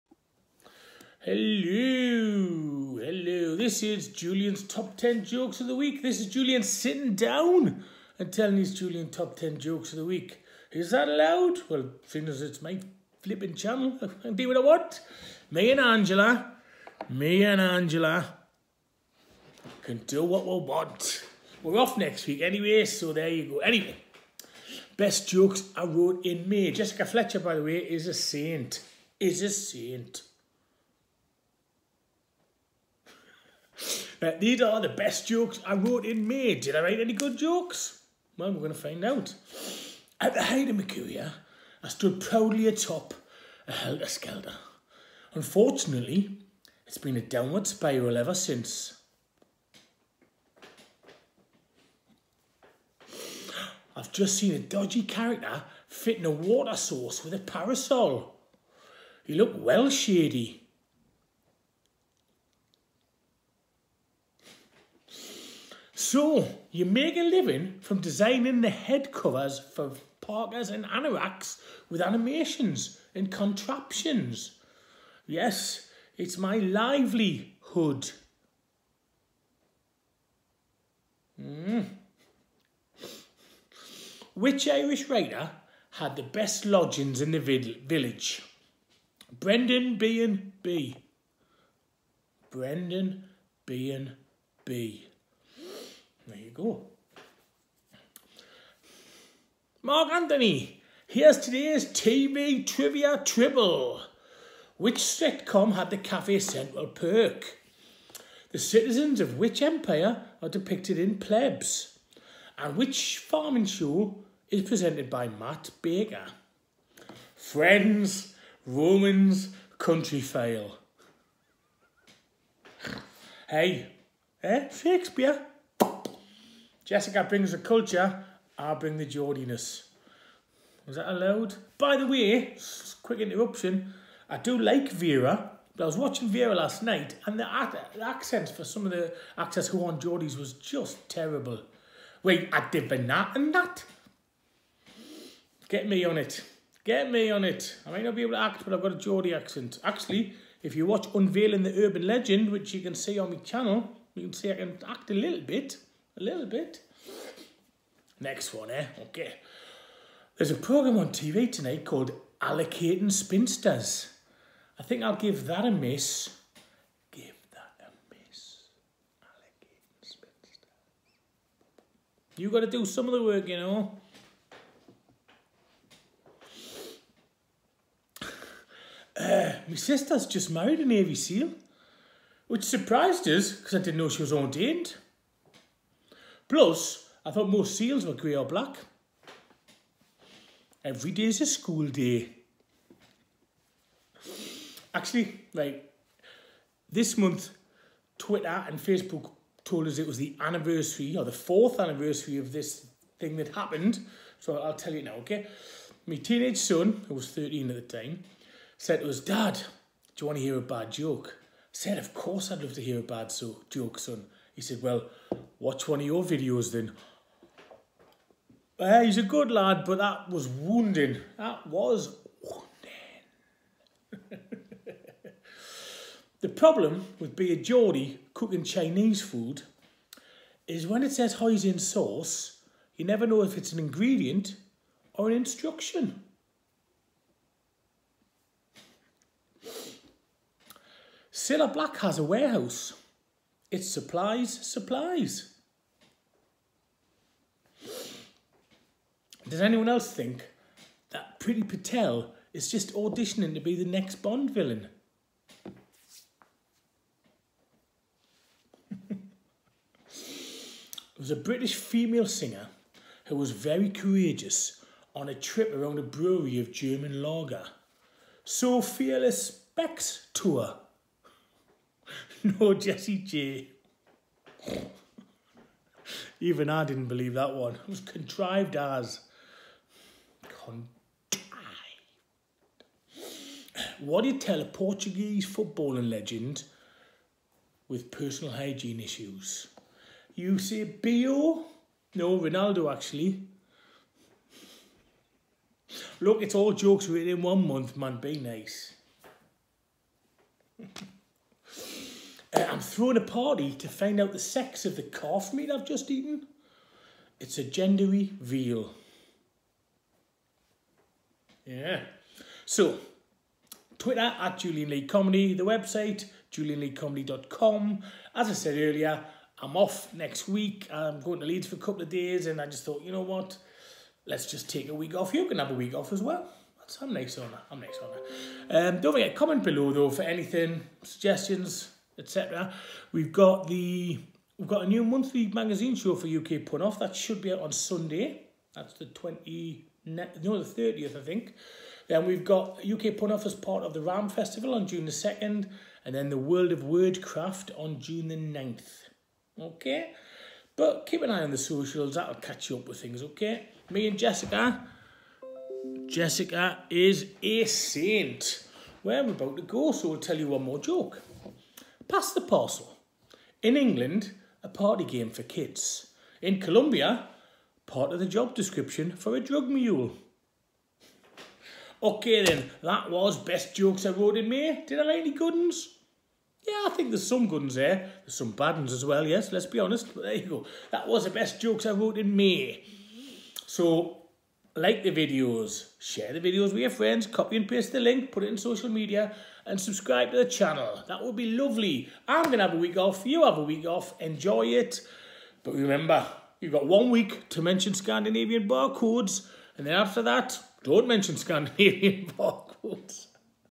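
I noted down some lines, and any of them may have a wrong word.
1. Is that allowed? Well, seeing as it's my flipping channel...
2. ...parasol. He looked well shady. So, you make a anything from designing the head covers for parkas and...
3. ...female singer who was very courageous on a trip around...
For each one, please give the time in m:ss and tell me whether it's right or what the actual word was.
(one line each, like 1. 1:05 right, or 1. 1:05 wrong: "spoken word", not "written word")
1. 0:10 right
2. 0:57 wrong: "living", not "anything"
3. 4:21 right.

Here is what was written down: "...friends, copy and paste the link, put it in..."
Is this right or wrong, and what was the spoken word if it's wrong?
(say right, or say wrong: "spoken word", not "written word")
right.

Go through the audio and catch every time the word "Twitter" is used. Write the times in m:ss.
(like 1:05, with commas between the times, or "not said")
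3:18, 5:13.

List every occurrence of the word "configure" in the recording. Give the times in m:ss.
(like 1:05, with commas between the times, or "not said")
not said.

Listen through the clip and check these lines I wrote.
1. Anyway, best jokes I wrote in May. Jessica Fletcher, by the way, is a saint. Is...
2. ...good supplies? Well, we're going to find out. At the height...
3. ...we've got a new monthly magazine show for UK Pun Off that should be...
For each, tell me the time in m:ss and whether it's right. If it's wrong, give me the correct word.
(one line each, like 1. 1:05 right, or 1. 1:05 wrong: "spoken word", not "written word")
1. 0:23 right
2. 0:37 wrong: "jokes", not "supplies"
3. 5:34 right.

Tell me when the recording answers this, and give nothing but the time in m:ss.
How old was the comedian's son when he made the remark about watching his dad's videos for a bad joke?
3:27.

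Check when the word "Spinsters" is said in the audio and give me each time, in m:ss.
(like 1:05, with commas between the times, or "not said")
2:43, 2:50.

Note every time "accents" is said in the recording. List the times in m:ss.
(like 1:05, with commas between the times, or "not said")
2:18, 2:29.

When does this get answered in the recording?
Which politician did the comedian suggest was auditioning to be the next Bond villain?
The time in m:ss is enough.
4:11.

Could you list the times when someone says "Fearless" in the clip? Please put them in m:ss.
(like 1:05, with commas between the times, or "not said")
4:28.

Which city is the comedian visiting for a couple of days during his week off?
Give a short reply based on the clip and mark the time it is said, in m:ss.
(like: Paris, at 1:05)
Leeds, at 5:21.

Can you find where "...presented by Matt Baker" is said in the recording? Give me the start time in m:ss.
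1:54.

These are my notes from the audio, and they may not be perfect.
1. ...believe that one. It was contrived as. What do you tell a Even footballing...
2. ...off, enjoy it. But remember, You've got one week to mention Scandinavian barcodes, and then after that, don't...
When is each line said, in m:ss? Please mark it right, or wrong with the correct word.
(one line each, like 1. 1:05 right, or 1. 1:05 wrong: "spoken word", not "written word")
1. 4:37 wrong: "Portuguese", not "Even"
2. 6:33 right.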